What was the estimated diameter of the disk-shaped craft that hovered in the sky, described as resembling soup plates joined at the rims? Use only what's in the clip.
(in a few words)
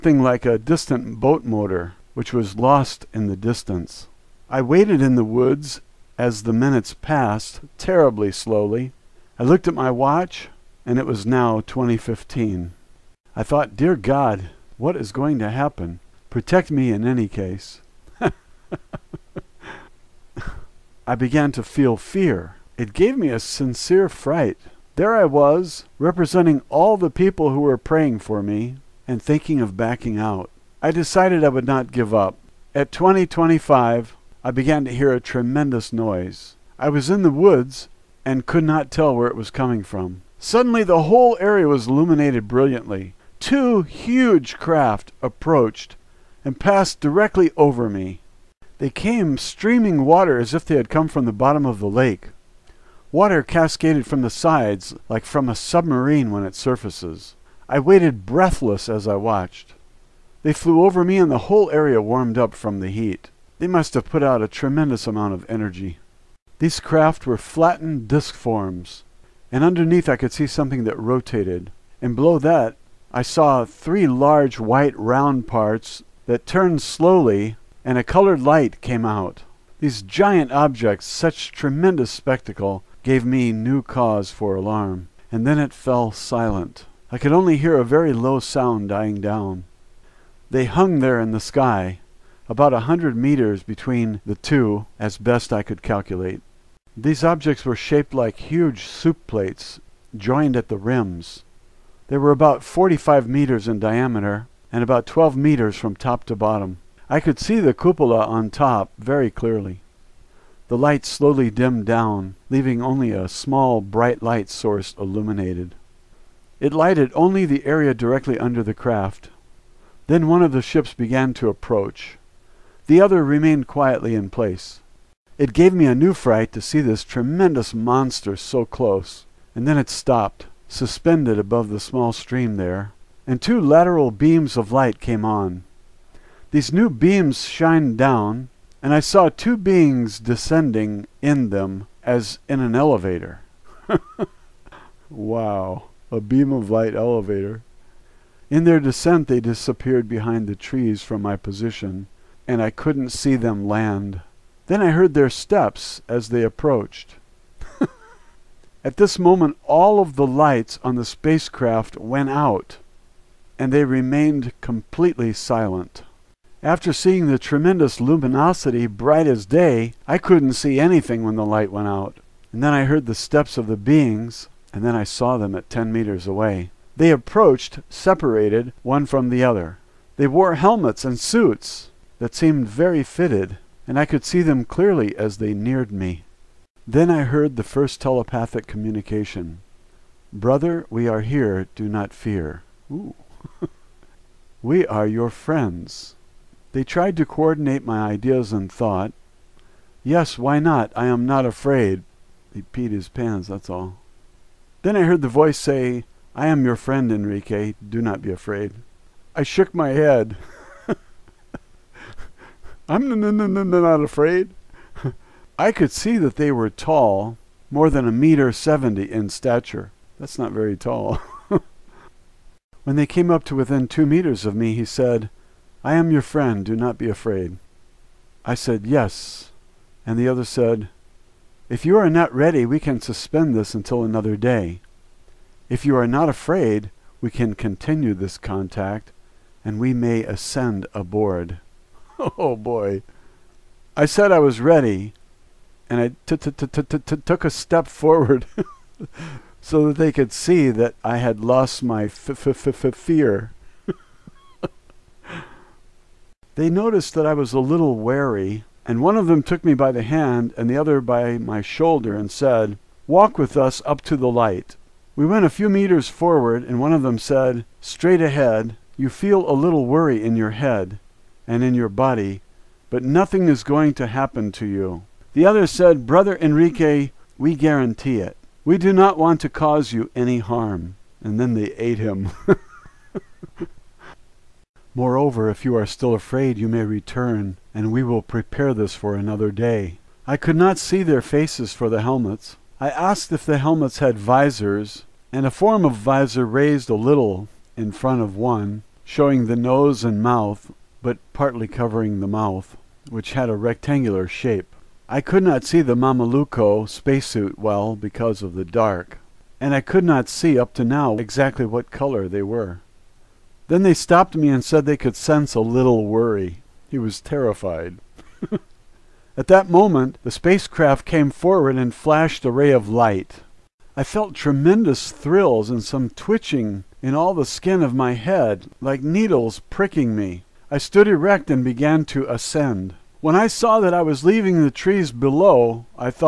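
45 meters.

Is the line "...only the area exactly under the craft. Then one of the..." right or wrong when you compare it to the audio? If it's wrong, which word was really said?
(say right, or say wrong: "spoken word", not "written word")
wrong: "directly", not "exactly".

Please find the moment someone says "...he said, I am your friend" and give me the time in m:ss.
3:44.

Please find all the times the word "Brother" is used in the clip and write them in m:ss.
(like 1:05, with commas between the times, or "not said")
3:10, 4:36.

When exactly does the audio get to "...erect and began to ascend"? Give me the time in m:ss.
5:31.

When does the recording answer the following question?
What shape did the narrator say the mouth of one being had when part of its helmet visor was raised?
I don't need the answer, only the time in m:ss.
5:03.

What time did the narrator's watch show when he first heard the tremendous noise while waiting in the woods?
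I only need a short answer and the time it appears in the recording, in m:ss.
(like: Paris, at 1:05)
2025, at 0:32.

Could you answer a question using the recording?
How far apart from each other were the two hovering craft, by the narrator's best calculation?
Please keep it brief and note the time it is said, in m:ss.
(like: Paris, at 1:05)
100 meters, at 1:32.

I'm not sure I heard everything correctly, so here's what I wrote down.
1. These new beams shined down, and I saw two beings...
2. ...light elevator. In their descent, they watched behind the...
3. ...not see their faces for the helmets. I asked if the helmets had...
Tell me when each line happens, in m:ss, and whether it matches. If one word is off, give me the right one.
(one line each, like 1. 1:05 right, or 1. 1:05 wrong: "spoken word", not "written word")
1. 2:16 right
2. 2:26 wrong: "disappeared", not "watched"
3. 4:50 right.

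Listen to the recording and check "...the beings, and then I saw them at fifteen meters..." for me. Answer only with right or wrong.
wrong.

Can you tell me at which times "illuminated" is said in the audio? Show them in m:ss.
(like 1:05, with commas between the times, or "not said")
0:41, 1:54.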